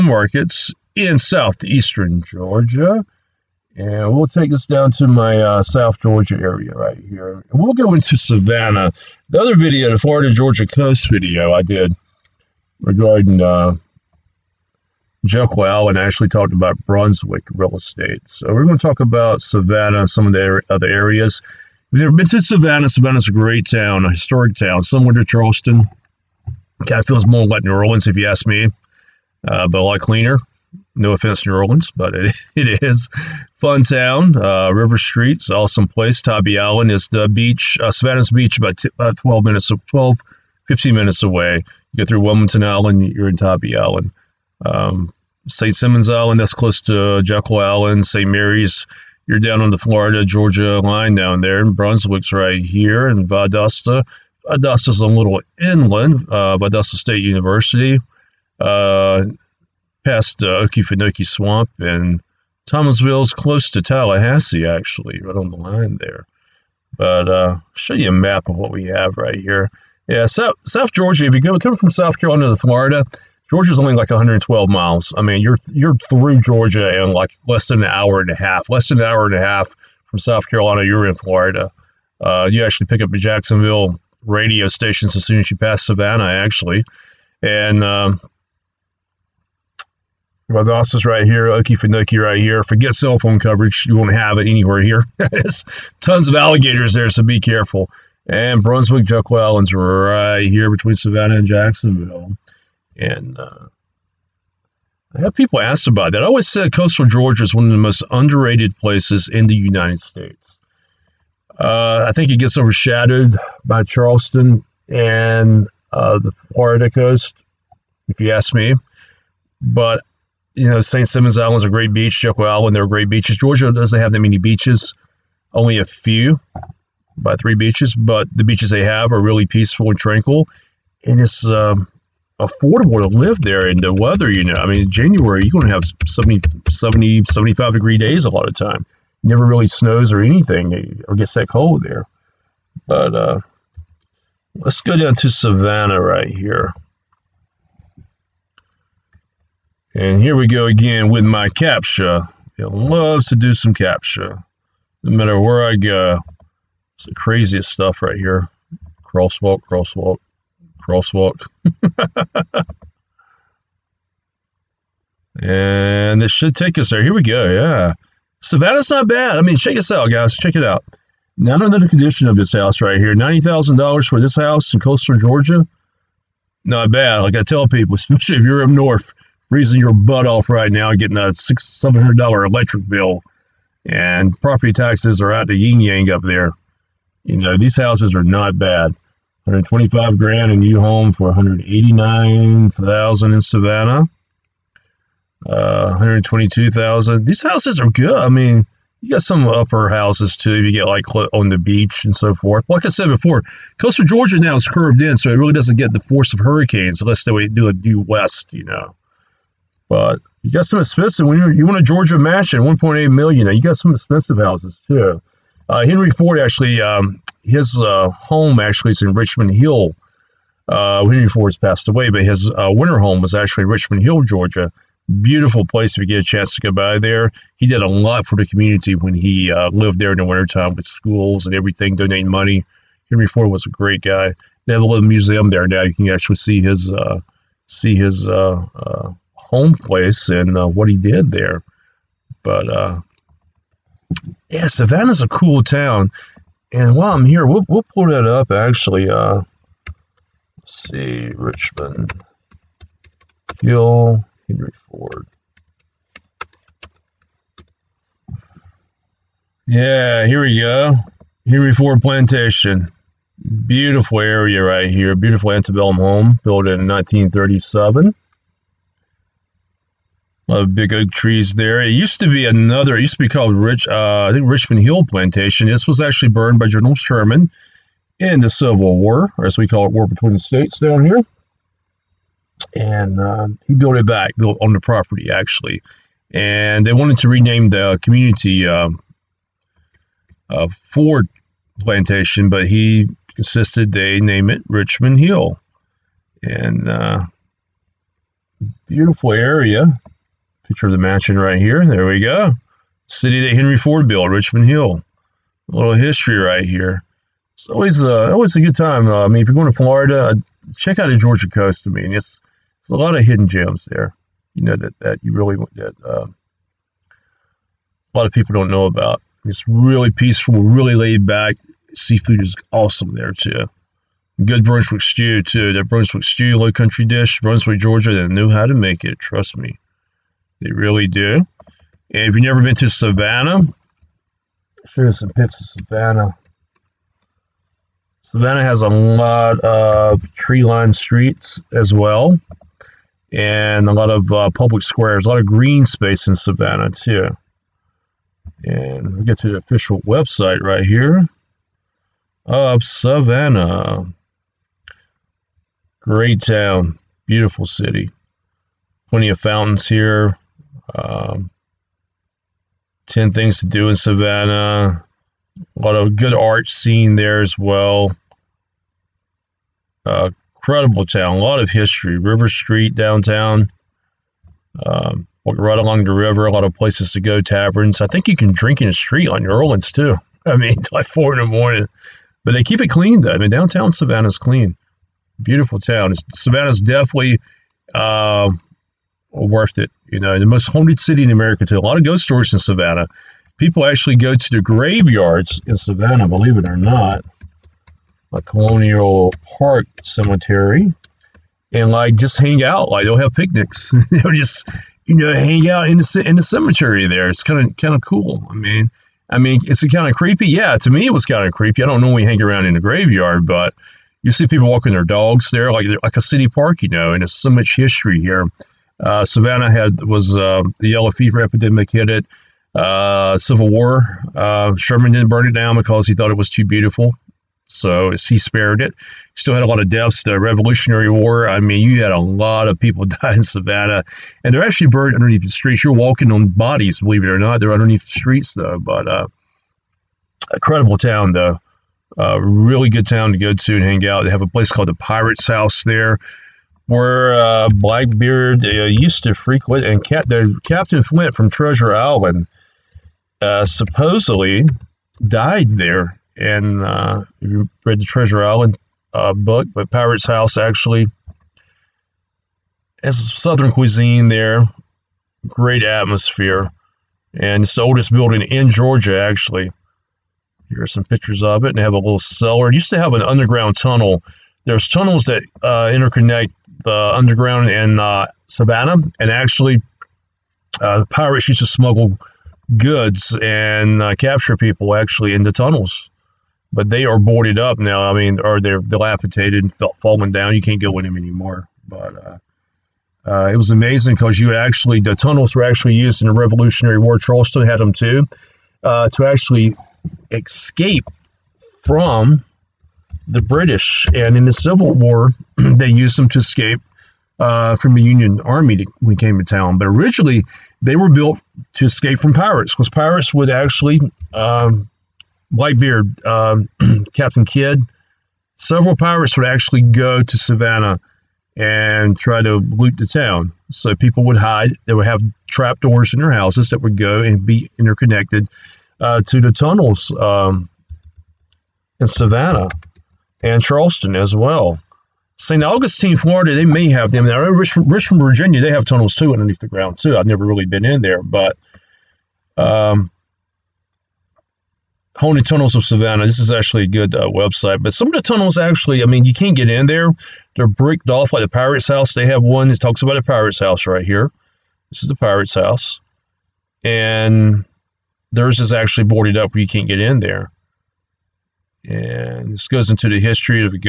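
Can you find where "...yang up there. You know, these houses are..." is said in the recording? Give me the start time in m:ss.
3:05.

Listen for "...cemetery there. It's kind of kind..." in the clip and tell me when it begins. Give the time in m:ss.
6:46.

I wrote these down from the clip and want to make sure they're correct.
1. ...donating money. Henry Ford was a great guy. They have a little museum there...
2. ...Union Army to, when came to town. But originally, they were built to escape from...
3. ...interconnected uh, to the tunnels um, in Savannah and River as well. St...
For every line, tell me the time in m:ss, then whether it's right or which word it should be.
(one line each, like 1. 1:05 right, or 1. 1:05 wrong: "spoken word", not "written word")
1. 3:51 right
2. 8:28 right
3. 8:47 wrong: "Charleston", not "River".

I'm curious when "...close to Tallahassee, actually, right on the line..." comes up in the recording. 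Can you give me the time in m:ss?
1:03.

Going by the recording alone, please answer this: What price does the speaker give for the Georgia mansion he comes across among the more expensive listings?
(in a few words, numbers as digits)
1.8 million.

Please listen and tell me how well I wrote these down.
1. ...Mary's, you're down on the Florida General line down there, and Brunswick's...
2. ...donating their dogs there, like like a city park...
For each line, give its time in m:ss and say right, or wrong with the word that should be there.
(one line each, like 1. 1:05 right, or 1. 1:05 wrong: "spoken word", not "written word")
1. 0:48 wrong: "Georgia", not "General"
2. 6:54 wrong: "walking", not "donating".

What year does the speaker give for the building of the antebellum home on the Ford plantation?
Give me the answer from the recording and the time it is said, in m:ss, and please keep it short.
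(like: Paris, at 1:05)
1937, at 4:26.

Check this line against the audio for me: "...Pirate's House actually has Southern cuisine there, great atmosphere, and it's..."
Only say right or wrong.
right.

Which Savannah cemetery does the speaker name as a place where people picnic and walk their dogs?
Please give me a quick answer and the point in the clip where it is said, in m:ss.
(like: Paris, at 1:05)
Colonial Park Cemetery, at 6:38.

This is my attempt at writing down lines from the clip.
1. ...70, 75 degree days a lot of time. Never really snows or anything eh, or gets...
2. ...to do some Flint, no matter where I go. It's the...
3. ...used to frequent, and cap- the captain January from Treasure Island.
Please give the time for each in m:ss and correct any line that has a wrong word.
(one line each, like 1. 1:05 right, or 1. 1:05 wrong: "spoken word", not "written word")
1. 2:16 right
2. 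2:33 wrong: "CAPTCHA", not "Flint"
3. 7:28 wrong: "Flint", not "January".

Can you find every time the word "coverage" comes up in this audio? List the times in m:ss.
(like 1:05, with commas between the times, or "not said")
1:33.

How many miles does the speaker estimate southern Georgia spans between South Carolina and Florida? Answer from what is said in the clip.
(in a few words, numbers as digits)
112 miles.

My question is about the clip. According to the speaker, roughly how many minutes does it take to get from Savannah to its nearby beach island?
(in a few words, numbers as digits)
12 to 15 minutes.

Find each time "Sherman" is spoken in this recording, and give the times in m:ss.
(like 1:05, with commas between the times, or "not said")
4:36, 7:04.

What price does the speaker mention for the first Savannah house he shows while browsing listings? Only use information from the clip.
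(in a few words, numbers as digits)
$90,000.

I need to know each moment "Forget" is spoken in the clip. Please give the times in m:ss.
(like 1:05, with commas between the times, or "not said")
1:32.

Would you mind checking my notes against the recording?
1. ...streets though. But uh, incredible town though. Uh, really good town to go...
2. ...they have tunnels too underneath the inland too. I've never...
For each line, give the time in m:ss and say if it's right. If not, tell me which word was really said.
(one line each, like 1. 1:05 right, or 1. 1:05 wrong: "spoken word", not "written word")
1. 7:18 right
2. 8:58 wrong: "ground", not "inland".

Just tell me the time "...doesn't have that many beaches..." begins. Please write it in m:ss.
2:03.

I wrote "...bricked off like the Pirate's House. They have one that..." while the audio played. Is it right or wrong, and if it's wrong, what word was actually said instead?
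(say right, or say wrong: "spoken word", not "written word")
right.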